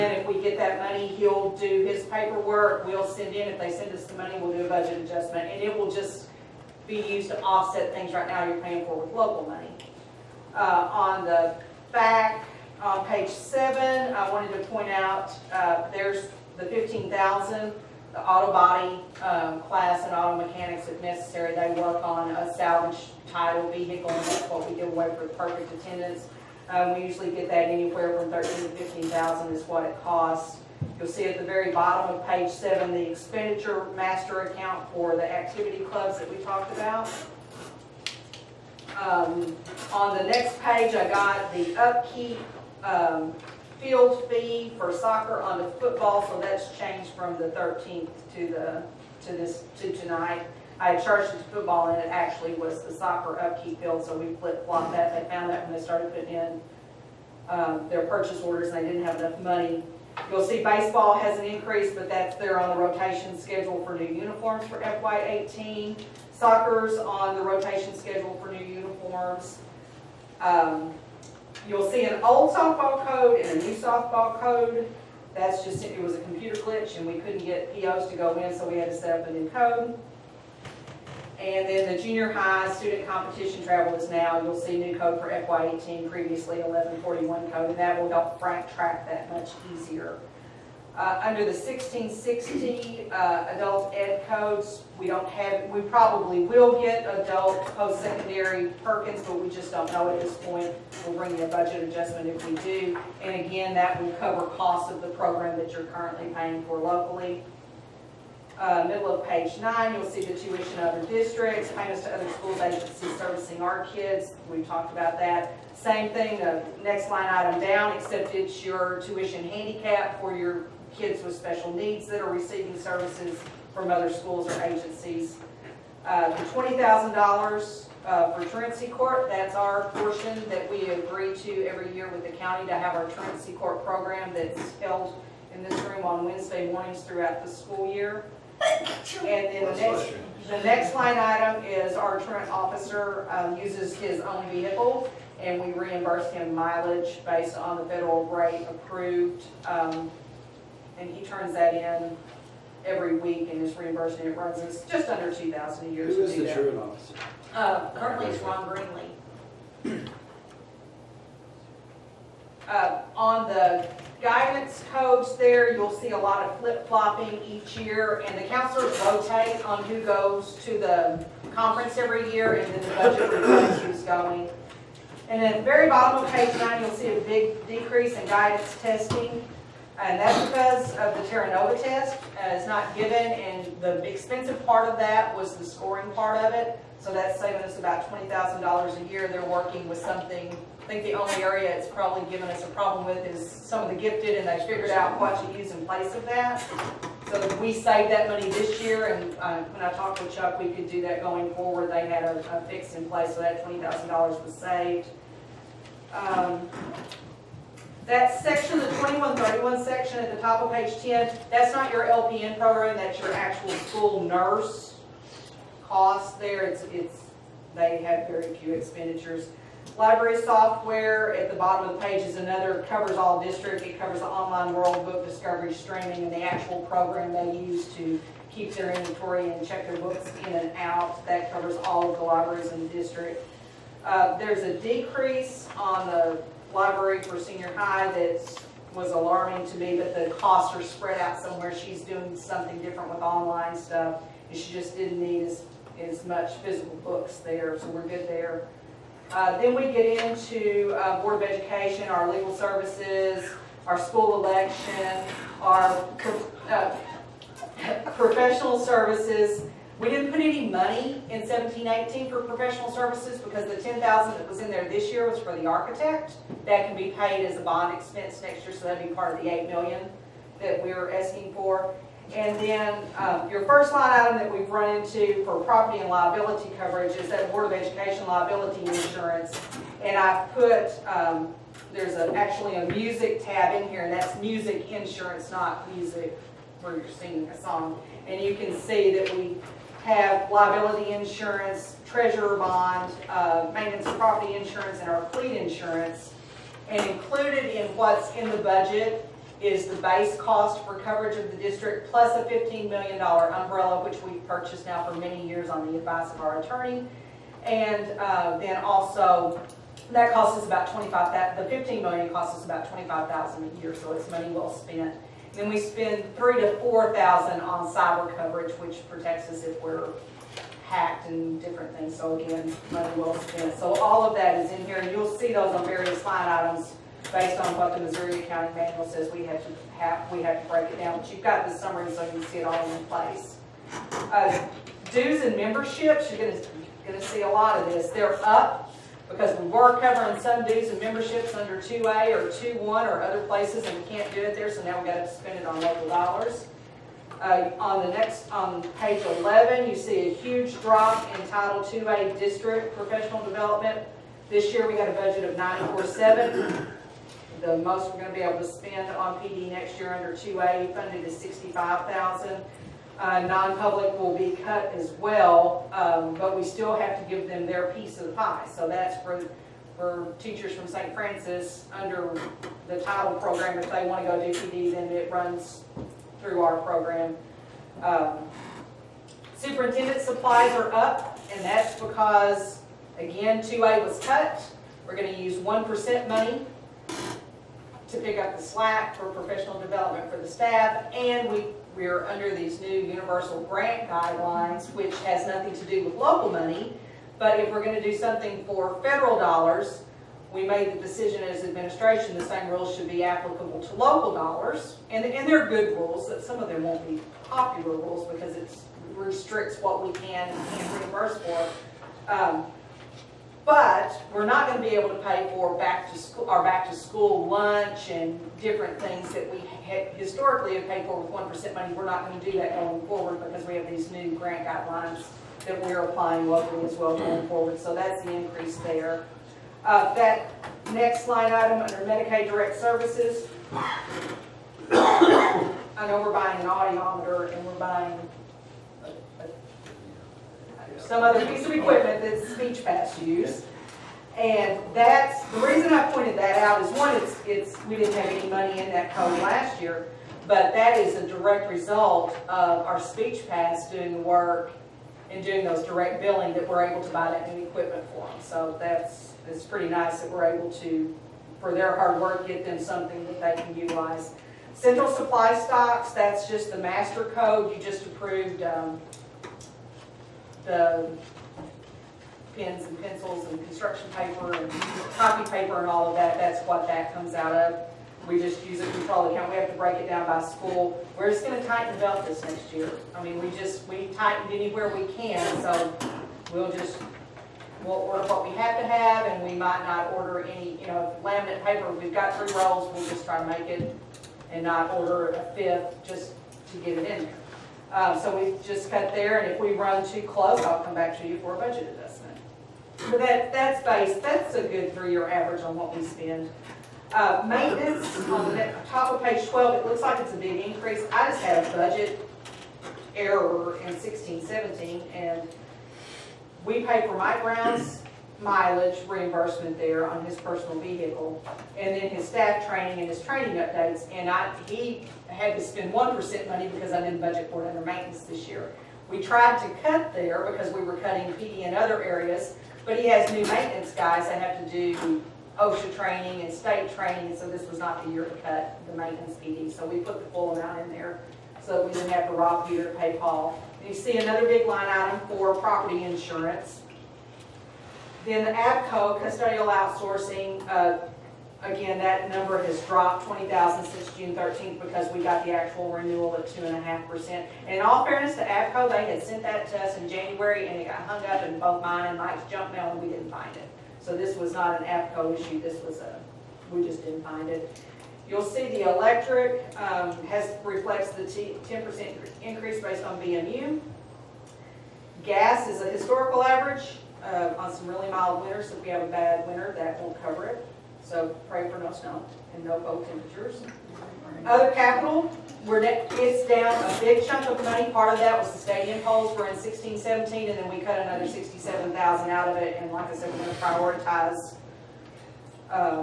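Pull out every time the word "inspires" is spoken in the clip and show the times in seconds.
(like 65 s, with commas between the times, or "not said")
not said.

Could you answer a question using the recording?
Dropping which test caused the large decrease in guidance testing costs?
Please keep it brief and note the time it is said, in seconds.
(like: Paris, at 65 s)
Terra Nova, at 181 s.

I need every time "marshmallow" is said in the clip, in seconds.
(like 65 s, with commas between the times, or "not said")
not said.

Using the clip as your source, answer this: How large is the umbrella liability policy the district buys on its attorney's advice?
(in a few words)
$15 million.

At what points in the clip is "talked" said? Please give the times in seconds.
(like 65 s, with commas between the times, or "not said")
36 s, 114 s, 199 s.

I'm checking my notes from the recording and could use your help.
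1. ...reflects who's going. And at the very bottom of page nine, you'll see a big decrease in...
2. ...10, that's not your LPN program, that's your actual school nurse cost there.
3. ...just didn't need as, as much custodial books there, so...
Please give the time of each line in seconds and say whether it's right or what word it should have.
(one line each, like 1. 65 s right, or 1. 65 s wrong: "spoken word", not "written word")
1. 173 s right
2. 211 s right
3. 244 s wrong: "physical", not "custodial".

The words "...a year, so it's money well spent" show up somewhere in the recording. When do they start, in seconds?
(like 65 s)
313 s.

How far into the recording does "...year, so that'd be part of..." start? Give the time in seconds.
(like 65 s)
268 s.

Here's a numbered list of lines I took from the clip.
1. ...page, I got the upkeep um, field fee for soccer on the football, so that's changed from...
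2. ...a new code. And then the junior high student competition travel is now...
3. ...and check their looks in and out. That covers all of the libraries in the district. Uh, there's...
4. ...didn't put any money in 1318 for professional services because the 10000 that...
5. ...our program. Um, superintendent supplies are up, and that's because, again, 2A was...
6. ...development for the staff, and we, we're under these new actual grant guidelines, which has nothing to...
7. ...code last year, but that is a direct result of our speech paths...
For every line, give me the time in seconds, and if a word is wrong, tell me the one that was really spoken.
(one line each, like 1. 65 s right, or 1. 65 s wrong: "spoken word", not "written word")
1. 40 s right
2. 79 s right
3. 229 s wrong: "books", not "looks"
4. 260 s wrong: "1718", not "1318"
5. 376 s right
6. 389 s wrong: "universal", not "actual"
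7. 449 s right.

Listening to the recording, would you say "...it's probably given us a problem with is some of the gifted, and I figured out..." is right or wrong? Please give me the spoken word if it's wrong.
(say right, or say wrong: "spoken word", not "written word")
right.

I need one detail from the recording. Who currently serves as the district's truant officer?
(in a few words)
Ron Greenley.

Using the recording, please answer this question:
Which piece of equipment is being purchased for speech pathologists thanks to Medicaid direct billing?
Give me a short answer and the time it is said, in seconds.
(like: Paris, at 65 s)
audiometer, at 436 s.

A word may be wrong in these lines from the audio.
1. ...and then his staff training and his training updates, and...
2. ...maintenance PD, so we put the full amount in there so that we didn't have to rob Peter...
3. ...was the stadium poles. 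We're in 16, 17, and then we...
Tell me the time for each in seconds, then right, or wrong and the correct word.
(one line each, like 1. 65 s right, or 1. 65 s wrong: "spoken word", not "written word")
1. 521 s right
2. 538 s right
3. 588 s right.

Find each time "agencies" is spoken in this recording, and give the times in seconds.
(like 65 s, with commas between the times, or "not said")
112 s, 124 s.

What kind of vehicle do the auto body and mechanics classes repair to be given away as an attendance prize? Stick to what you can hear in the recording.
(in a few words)
salvage title vehicle.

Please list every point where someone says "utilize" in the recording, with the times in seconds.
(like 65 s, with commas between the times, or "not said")
463 s.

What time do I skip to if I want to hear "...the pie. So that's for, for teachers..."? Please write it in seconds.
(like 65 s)
368 s.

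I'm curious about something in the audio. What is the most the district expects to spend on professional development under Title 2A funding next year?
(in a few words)
65,000.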